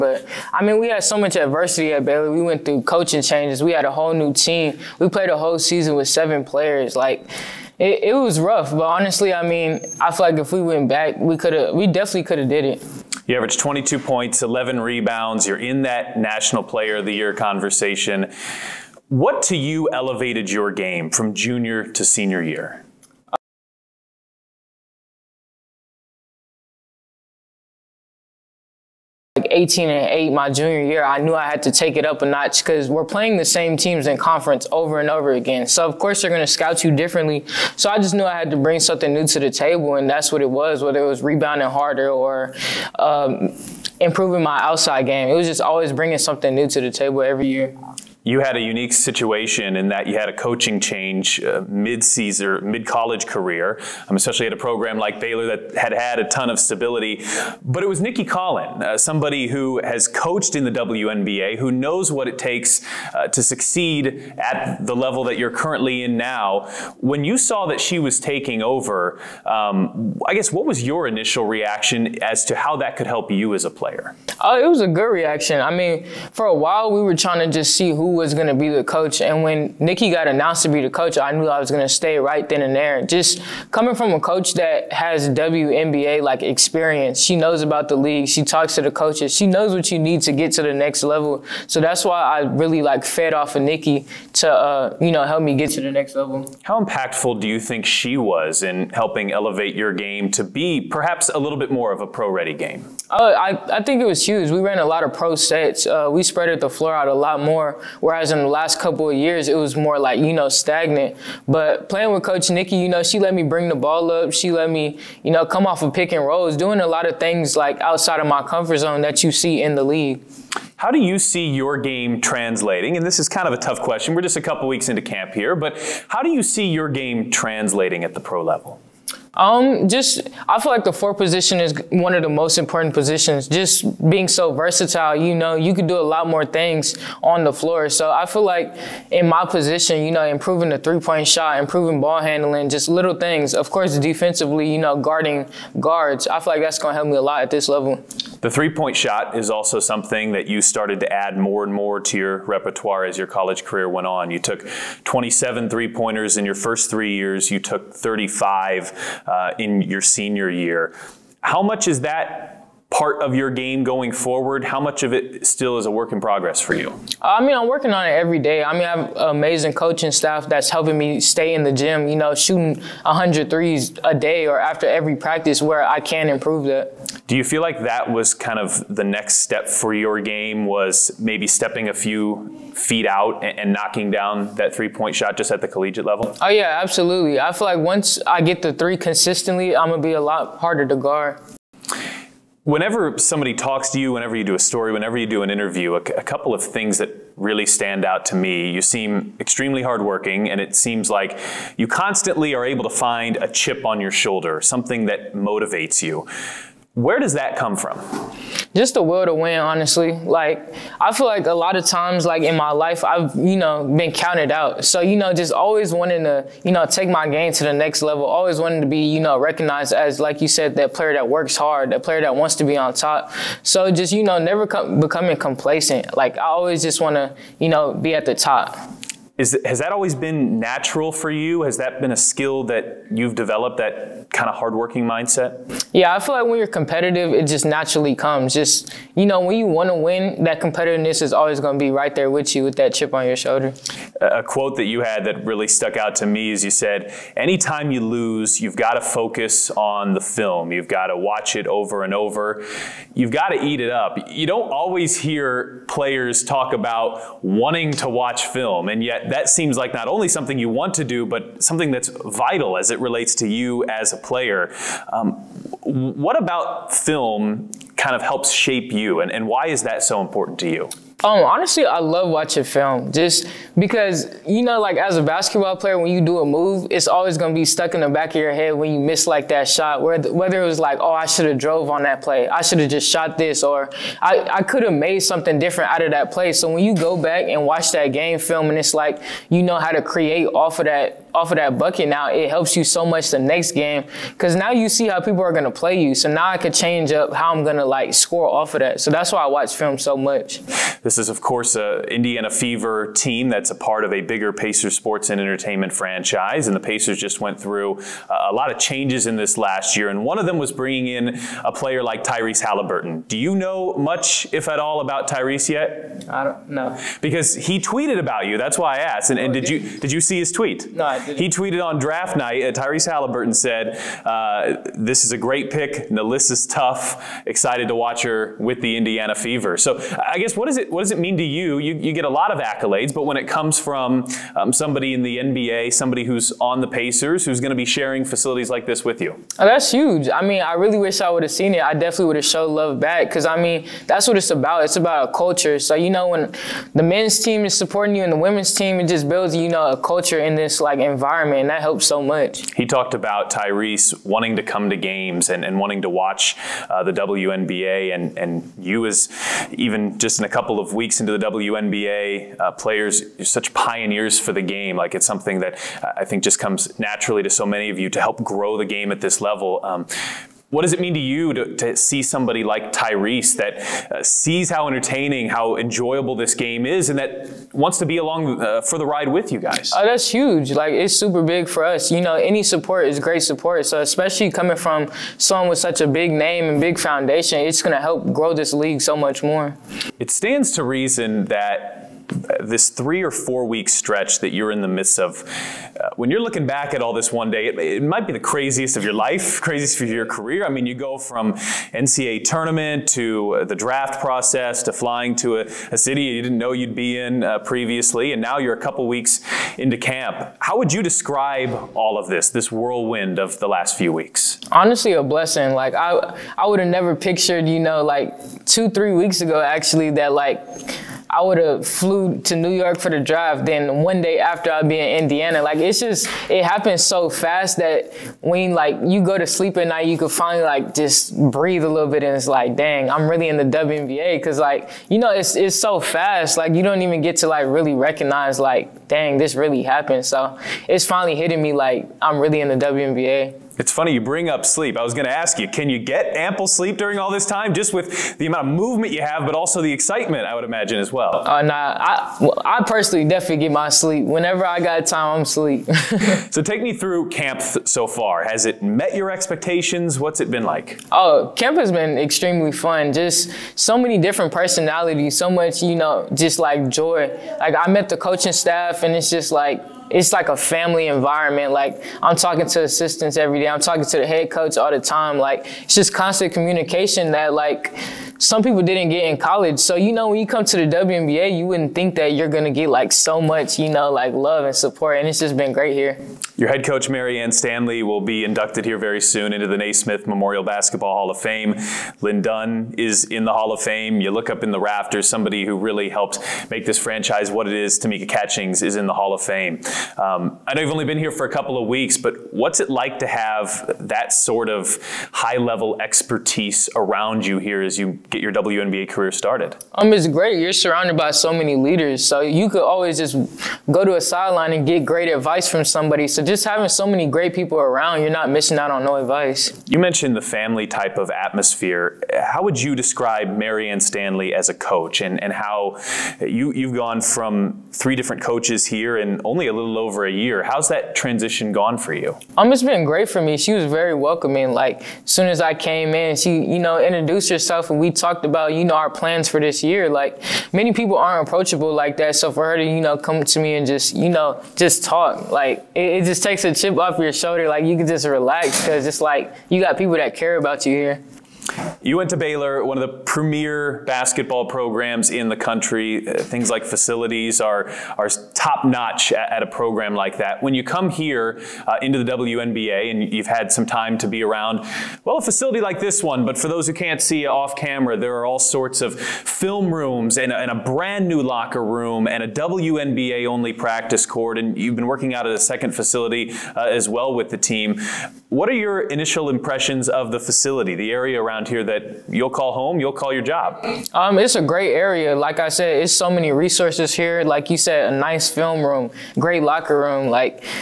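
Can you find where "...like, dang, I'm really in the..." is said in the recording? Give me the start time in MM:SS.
07:12.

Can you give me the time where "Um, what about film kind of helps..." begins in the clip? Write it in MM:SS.
04:25.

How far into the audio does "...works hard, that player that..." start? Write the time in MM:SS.
03:41.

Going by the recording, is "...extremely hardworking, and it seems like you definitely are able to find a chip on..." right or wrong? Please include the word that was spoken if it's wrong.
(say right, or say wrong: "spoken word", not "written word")
wrong: "constantly", not "definitely".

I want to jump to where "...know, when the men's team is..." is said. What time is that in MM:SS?
05:46.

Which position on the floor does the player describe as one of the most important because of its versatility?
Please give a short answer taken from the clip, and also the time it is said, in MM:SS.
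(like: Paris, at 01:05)
the four, at 02:10.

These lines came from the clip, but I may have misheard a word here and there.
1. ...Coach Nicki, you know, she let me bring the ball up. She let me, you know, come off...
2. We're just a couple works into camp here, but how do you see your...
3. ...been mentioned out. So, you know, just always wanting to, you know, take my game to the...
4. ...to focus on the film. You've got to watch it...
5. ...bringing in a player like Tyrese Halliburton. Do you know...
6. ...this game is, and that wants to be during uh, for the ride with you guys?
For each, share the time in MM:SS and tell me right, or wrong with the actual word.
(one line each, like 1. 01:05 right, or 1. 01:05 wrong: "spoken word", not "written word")
1. 01:52 right
2. 02:04 wrong: "weeks", not "works"
3. 03:33 wrong: "counted", not "mentioned"
4. 04:08 right
5. 05:10 right
6. 06:16 wrong: "along", not "during".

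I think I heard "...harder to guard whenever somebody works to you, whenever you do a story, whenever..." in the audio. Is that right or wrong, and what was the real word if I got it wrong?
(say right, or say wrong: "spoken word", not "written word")
wrong: "talks", not "works".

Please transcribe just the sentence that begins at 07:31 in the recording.
Uh, nah, I, well, I personally definitely get my sleep.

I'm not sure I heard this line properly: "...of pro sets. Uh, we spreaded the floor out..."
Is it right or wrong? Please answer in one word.
right.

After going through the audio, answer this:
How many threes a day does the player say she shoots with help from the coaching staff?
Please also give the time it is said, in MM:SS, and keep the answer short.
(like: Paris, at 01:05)
100, at 02:53.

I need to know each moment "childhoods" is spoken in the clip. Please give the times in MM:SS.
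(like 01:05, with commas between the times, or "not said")
not said.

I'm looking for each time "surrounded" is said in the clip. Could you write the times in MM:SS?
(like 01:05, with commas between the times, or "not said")
08:30.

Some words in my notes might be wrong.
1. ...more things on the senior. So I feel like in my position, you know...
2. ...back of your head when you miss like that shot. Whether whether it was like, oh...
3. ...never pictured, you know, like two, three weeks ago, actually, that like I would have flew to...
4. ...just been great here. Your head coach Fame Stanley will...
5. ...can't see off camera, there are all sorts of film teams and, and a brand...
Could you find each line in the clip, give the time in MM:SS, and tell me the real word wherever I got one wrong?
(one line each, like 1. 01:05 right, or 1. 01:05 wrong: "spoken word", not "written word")
1. 02:16 wrong: "floor", not "senior"
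2. 04:38 right
3. 06:56 right
4. 08:05 wrong: "Marianne", not "Fame"
5. 09:26 wrong: "rooms", not "teams".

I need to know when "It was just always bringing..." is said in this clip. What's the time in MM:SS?
00:45.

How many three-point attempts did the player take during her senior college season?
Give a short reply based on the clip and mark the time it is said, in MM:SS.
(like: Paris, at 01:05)
35, at 02:37.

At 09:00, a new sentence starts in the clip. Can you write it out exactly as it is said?
Like, many people aren't approachable like that.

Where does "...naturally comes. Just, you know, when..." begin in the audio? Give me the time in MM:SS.
03:57.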